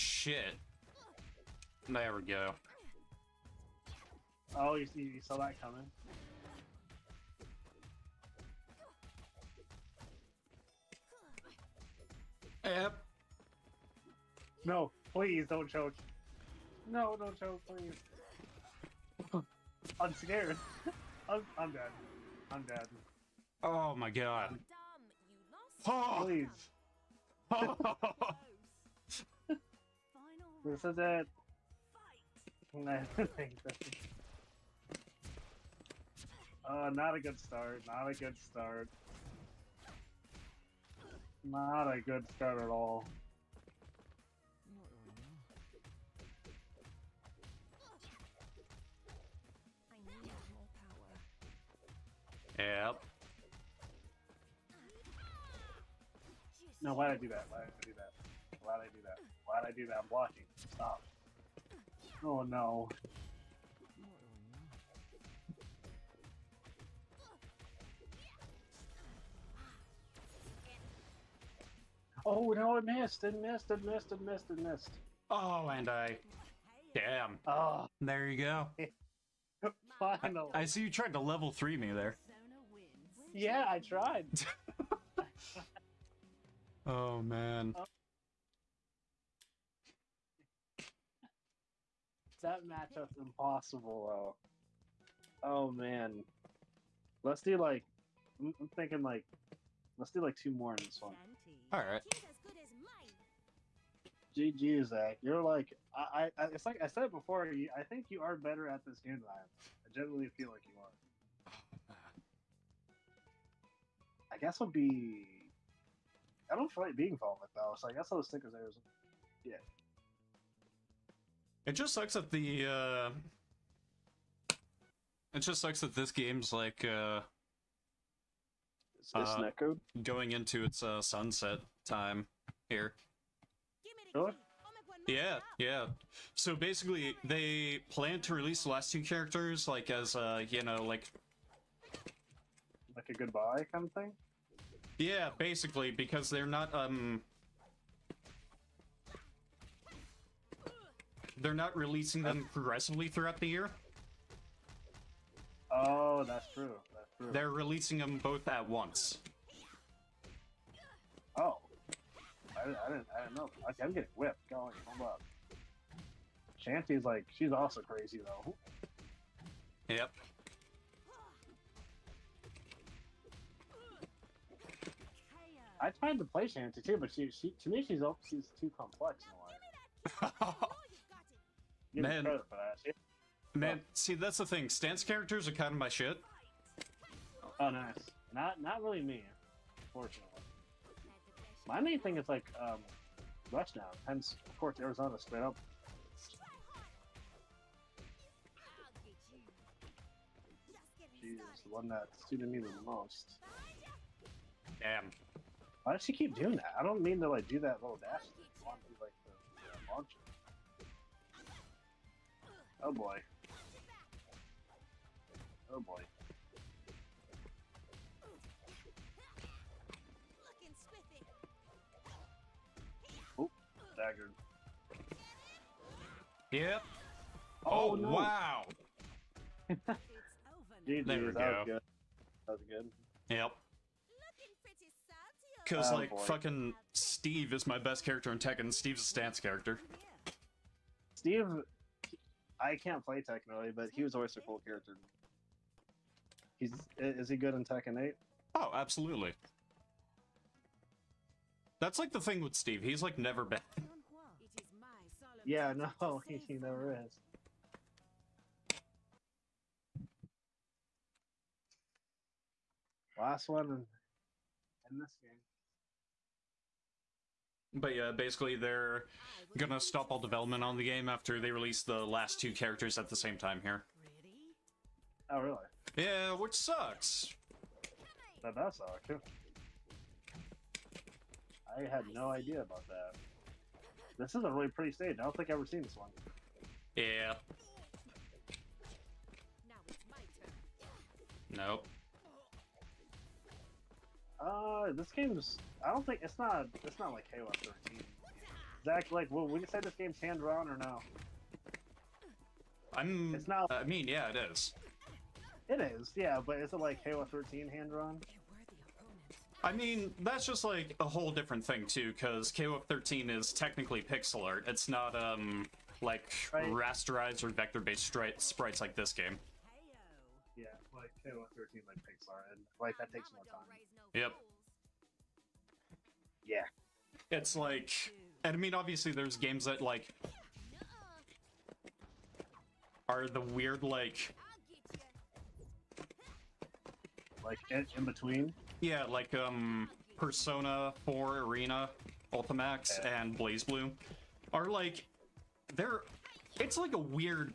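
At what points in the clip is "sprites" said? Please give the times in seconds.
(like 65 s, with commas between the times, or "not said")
318 s.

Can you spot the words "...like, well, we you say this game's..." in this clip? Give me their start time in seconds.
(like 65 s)
299 s.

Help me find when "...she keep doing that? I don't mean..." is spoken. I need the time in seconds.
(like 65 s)
206 s.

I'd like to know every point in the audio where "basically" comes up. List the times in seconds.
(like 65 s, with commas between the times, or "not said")
136 s, 145 s, 268 s.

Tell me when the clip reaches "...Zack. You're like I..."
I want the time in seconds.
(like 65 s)
104 s.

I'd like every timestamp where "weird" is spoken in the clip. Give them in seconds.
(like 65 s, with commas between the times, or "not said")
333 s, 346 s.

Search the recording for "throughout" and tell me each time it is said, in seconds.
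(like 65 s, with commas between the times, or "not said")
153 s.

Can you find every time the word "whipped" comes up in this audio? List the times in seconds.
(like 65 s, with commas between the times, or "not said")
164 s.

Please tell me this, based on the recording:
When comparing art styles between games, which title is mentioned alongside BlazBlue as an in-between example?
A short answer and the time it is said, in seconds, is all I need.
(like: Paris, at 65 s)
Persona 4 Arena Ultimax, at 340 s.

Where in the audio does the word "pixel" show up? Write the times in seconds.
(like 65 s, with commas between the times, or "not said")
314 s, 321 s.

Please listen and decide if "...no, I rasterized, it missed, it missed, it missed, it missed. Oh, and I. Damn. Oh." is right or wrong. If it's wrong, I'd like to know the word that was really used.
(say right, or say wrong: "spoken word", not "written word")
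wrong: "missed", not "rasterized".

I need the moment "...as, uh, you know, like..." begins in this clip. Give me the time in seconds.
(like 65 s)
139 s.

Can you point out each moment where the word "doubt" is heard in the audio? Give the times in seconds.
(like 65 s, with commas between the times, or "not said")
not said.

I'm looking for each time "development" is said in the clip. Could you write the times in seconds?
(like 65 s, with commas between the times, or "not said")
270 s.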